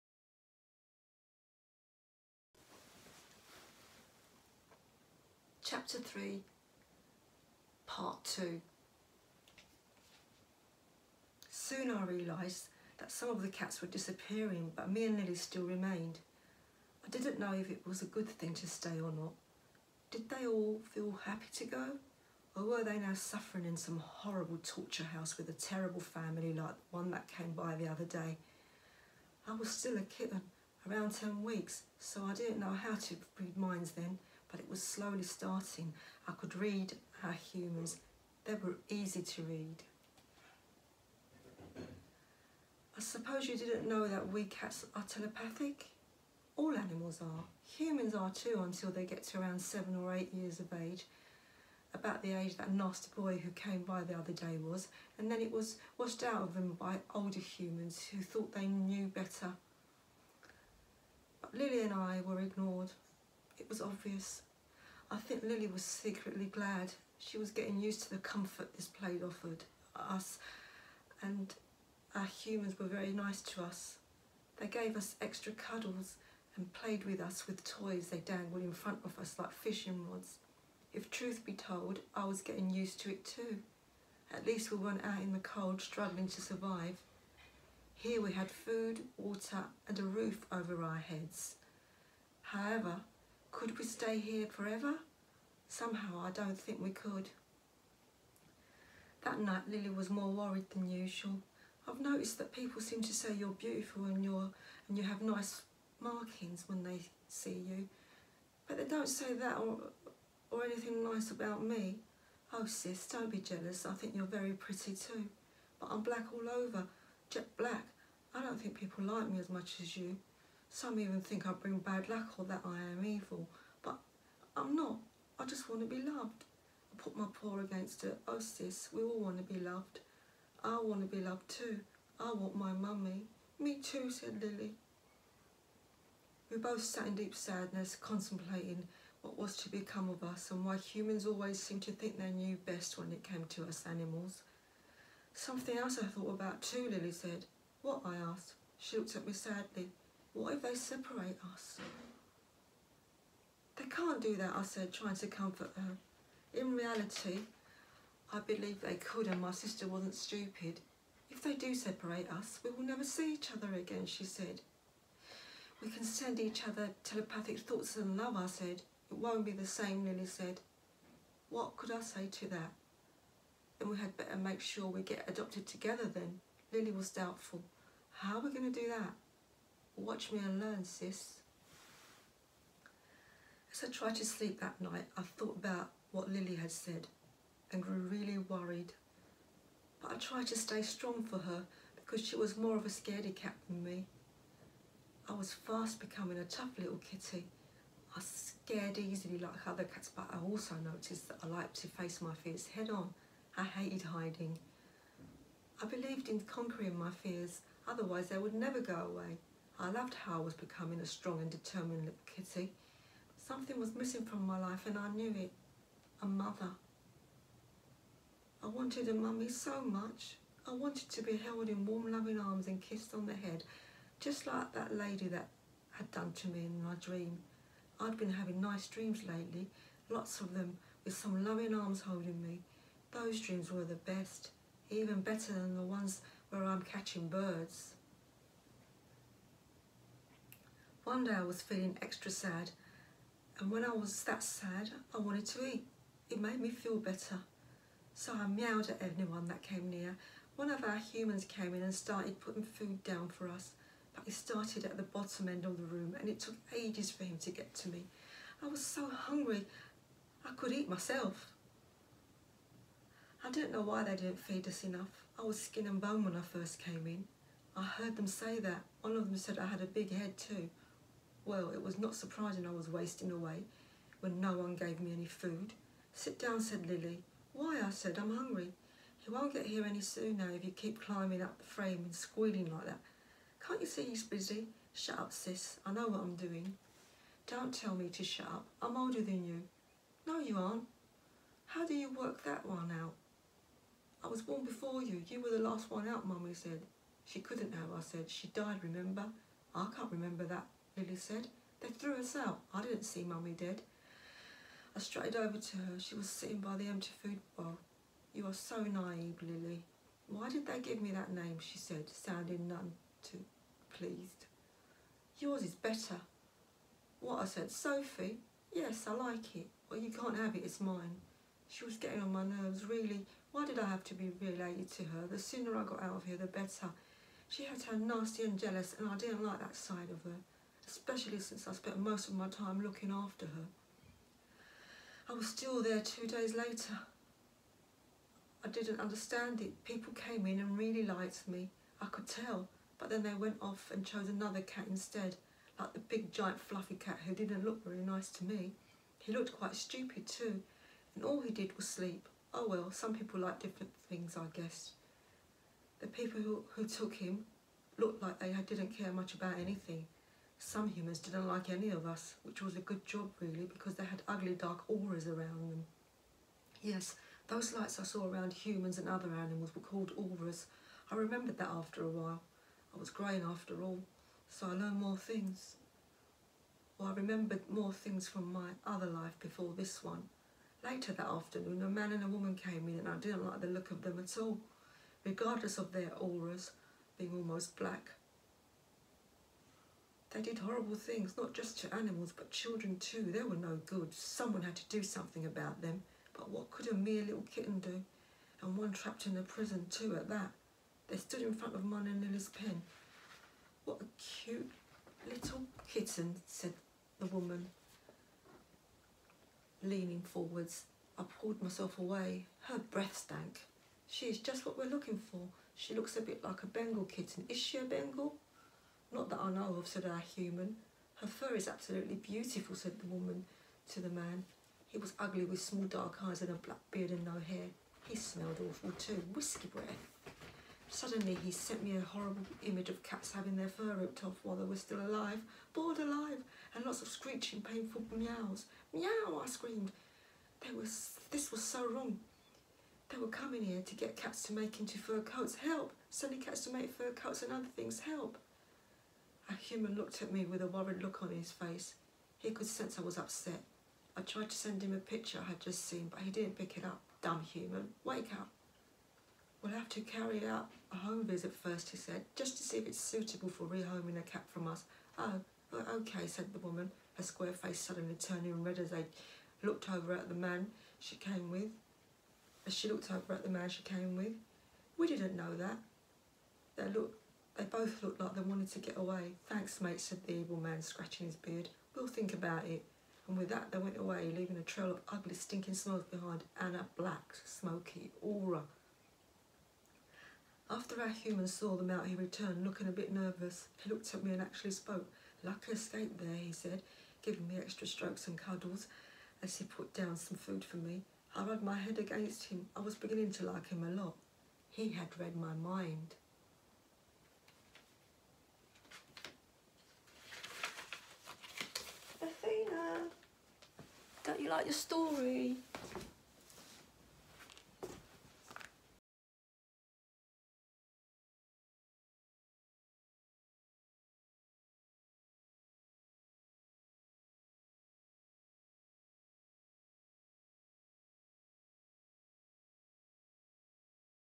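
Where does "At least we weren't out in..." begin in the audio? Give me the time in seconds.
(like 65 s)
84 s.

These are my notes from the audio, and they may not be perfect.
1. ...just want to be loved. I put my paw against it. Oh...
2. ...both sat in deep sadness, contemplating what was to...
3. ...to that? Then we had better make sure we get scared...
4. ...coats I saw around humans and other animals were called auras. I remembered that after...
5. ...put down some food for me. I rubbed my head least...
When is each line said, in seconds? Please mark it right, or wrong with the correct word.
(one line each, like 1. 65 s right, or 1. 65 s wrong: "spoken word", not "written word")
1. 125 s right
2. 136 s right
3. 172 s wrong: "adopted", not "scared"
4. 367 s wrong: "lights", not "coats"
5. 499 s wrong: "against", not "least".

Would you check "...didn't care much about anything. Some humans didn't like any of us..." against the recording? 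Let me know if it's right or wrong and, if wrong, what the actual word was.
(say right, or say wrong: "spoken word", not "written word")
right.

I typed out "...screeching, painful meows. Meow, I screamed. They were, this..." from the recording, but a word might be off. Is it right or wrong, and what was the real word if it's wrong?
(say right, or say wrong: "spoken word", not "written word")
right.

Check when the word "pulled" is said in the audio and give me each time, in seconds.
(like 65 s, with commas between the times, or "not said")
411 s.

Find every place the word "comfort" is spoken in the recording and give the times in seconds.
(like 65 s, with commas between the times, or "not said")
68 s, 155 s.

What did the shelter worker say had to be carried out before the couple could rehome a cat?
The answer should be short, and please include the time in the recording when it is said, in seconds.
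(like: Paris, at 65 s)
a home visit, at 460 s.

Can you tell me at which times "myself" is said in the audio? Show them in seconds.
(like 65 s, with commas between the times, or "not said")
260 s, 411 s.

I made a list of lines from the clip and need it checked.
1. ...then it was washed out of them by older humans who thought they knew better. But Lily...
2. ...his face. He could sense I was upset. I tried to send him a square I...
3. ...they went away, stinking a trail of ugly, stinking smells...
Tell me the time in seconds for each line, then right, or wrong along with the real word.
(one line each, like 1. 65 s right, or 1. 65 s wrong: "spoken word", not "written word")
1. 55 s right
2. 451 s wrong: "picture", not "square"
3. 483 s wrong: "leaving", not "stinking".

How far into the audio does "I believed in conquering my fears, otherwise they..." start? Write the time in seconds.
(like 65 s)
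205 s.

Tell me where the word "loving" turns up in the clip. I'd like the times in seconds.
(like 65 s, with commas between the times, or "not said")
222 s, 231 s.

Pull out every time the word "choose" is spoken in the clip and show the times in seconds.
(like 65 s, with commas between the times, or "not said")
not said.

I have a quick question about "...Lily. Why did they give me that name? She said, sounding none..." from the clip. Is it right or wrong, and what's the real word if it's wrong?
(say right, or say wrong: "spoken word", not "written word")
right.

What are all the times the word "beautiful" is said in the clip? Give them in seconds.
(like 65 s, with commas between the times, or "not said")
103 s, 422 s.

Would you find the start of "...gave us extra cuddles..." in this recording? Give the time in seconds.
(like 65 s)
74 s.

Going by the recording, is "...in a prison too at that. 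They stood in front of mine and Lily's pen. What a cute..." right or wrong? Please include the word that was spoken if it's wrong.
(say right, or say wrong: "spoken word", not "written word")
right.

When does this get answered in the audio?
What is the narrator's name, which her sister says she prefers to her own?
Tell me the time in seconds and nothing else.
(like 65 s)
317 s.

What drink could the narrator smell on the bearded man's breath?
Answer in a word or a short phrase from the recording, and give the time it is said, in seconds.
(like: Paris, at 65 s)
whisky, at 429 s.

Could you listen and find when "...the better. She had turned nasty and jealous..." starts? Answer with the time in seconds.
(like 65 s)
326 s.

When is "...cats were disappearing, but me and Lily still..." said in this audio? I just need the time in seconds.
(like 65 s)
13 s.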